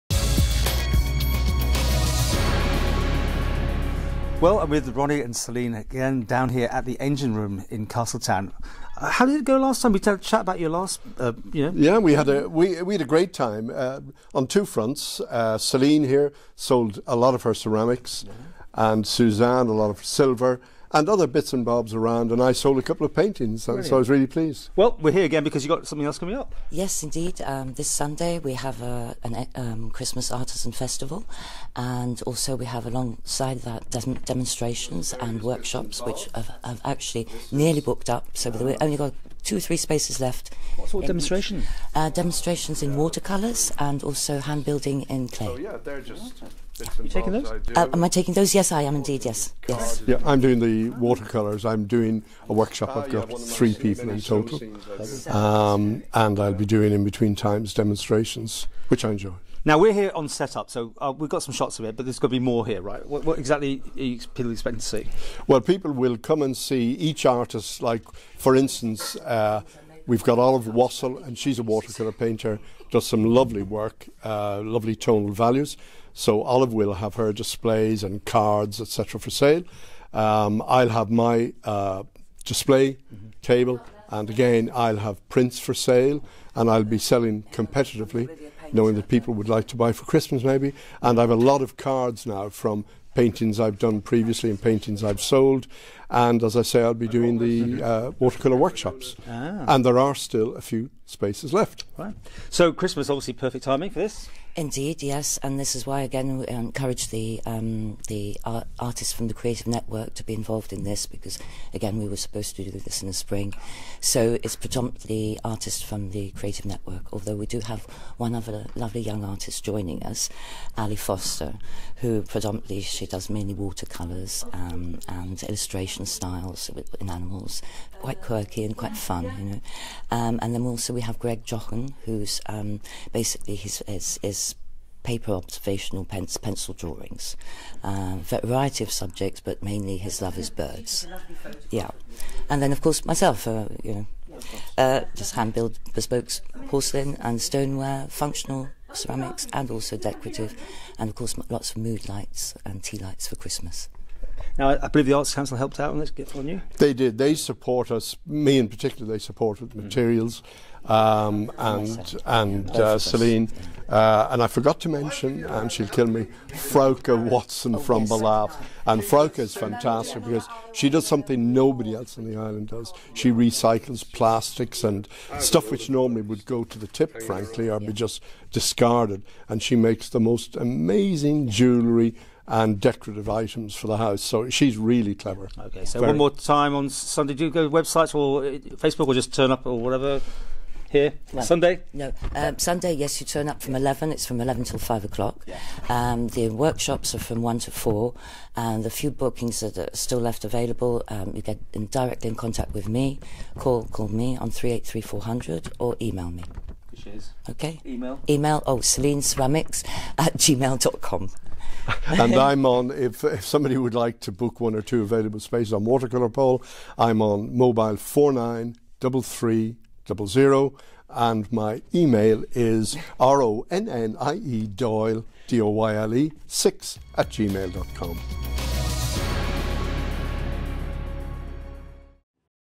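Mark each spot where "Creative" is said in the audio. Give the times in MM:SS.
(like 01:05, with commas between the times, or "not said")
01:49, 01:56.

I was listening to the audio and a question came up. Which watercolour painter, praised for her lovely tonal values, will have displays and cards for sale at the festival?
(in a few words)
Olive Wassel.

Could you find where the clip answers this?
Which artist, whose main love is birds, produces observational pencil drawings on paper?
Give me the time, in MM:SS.
02:11.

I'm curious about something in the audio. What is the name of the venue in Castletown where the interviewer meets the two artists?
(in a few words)
The Engine Room.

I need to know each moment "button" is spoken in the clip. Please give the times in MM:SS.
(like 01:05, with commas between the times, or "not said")
not said.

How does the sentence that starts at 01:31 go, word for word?
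And I have a lot of cards now from paintings I've done previously and paintings I've sold.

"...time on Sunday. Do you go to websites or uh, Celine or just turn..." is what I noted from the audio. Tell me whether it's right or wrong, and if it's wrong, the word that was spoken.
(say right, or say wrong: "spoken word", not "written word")
wrong: "Facebook", not "Celine".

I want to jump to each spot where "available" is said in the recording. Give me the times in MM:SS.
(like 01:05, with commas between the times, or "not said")
03:20, 03:35.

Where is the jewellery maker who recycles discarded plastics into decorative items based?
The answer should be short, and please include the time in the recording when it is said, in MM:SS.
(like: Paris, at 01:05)
Ballaugh, at 02:48.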